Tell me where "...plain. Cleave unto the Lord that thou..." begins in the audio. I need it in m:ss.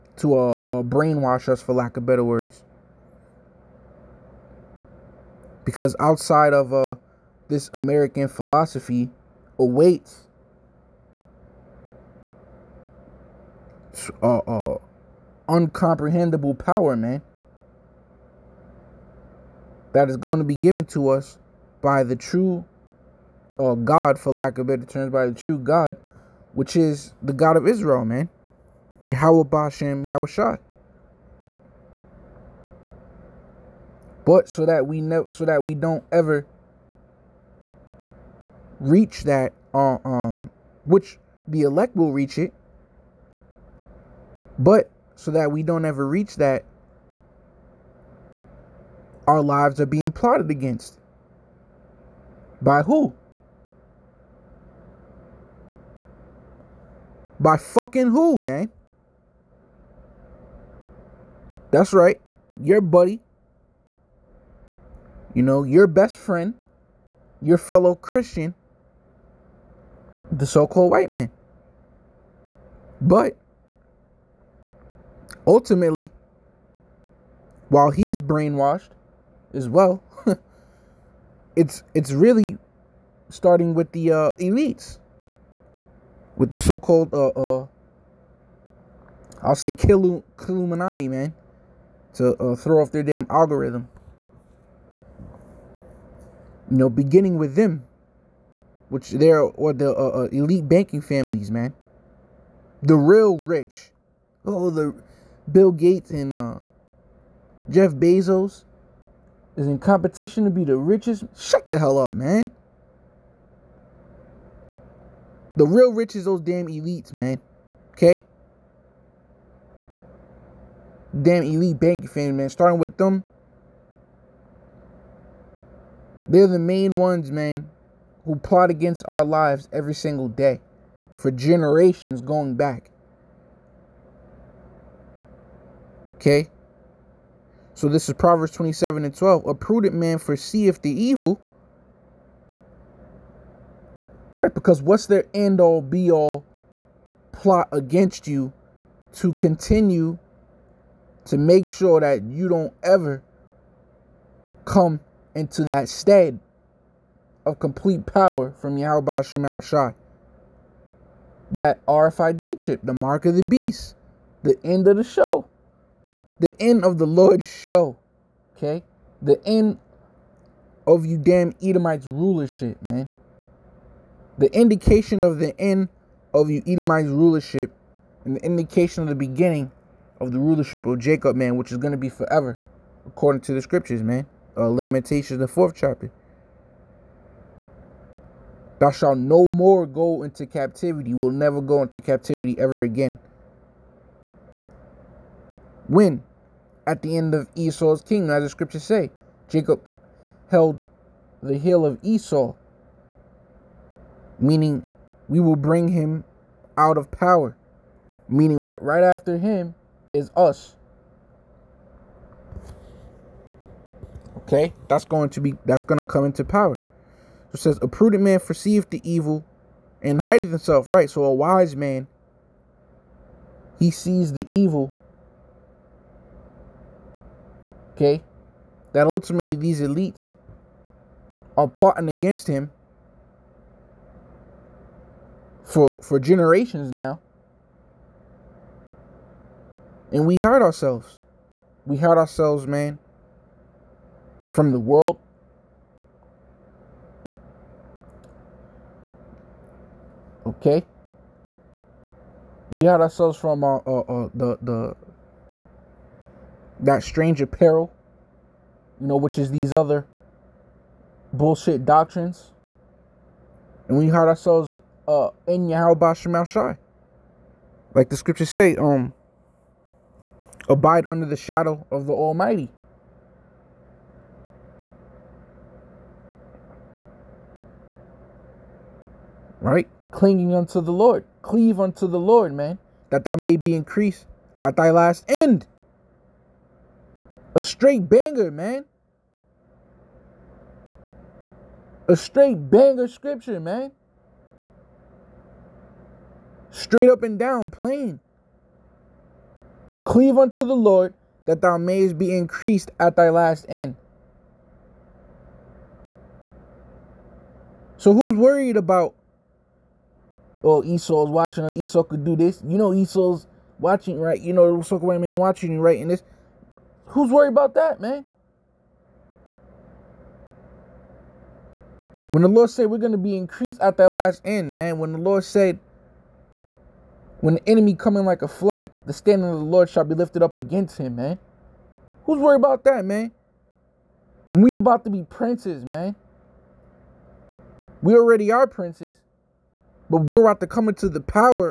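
4:57.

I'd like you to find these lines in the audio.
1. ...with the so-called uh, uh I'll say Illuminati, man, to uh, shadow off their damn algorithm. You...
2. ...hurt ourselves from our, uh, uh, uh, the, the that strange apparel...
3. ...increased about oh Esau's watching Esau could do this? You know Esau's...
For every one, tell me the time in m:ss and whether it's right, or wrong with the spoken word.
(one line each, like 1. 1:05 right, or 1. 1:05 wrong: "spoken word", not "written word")
1. 1:26 wrong: "throw", not "shadow"
2. 4:12 right
3. 5:08 wrong: "worried", not "increased".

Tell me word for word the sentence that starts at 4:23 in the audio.
And we hide ourselves uh, in Yahweh Shemel Shai.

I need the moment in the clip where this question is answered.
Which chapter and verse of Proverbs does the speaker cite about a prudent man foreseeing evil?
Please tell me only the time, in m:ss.
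2:18.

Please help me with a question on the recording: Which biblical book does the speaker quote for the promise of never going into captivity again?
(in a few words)
Lamentations.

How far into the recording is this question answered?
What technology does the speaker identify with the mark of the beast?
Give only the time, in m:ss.
2:41.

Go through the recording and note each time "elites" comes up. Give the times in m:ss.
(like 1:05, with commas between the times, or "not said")
1:24, 1:40, 1:56, 2:01, 3:49.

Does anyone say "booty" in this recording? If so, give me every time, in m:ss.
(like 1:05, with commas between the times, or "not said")
not said.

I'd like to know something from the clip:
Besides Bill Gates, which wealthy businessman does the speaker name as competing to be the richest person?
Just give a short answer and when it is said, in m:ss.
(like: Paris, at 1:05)
Jeff Bezos, at 1:47.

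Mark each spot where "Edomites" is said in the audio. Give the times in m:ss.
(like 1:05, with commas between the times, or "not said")
2:51, 2:56.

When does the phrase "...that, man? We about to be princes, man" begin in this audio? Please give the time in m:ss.
5:32.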